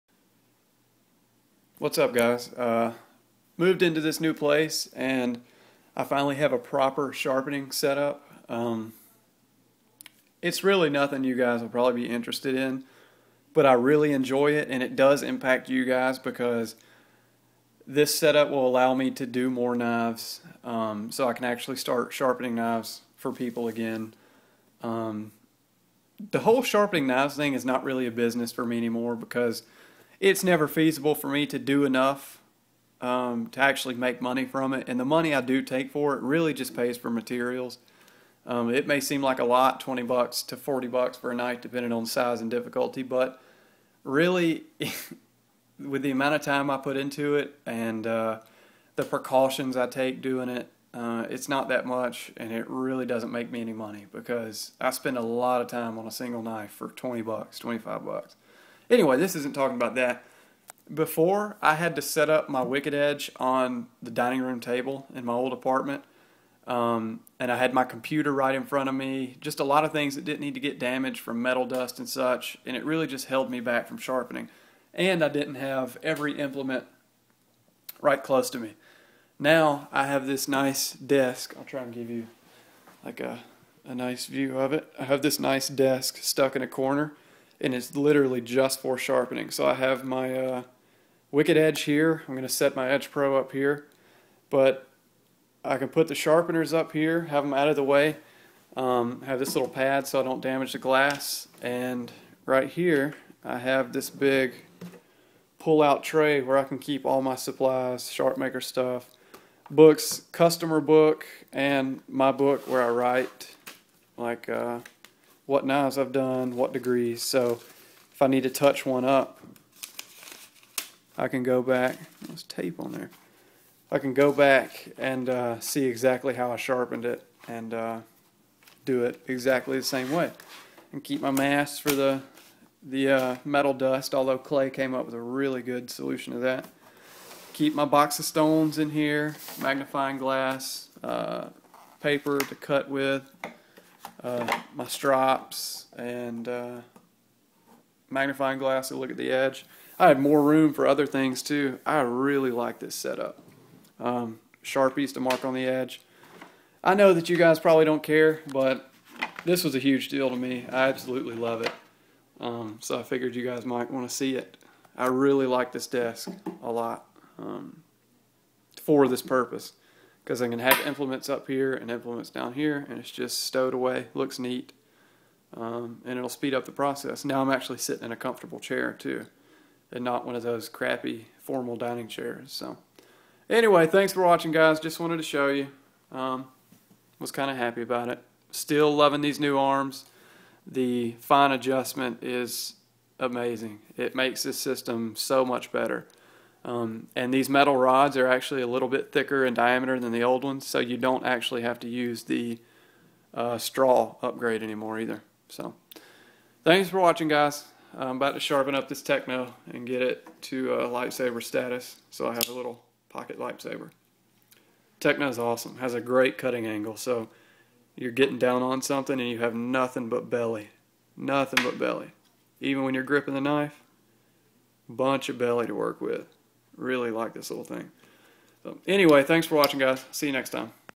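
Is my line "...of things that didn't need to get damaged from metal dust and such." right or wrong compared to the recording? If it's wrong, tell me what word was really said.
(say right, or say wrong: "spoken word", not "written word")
right.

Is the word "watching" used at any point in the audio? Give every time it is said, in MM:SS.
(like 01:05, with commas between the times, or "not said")
03:04, 03:26, 03:49.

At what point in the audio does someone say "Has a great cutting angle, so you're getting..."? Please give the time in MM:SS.
03:35.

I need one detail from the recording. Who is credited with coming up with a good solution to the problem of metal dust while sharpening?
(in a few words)
Clay.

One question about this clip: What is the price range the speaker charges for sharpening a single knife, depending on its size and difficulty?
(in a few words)
$20 to $40.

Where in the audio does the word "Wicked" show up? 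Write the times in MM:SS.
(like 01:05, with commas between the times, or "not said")
01:02, 01:31.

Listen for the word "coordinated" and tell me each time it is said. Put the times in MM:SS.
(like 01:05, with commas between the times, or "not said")
not said.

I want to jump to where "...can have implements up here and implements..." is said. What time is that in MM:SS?
02:50.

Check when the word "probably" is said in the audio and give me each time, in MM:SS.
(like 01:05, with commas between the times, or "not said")
00:11, 02:37.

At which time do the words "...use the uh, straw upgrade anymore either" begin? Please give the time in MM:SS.
03:21.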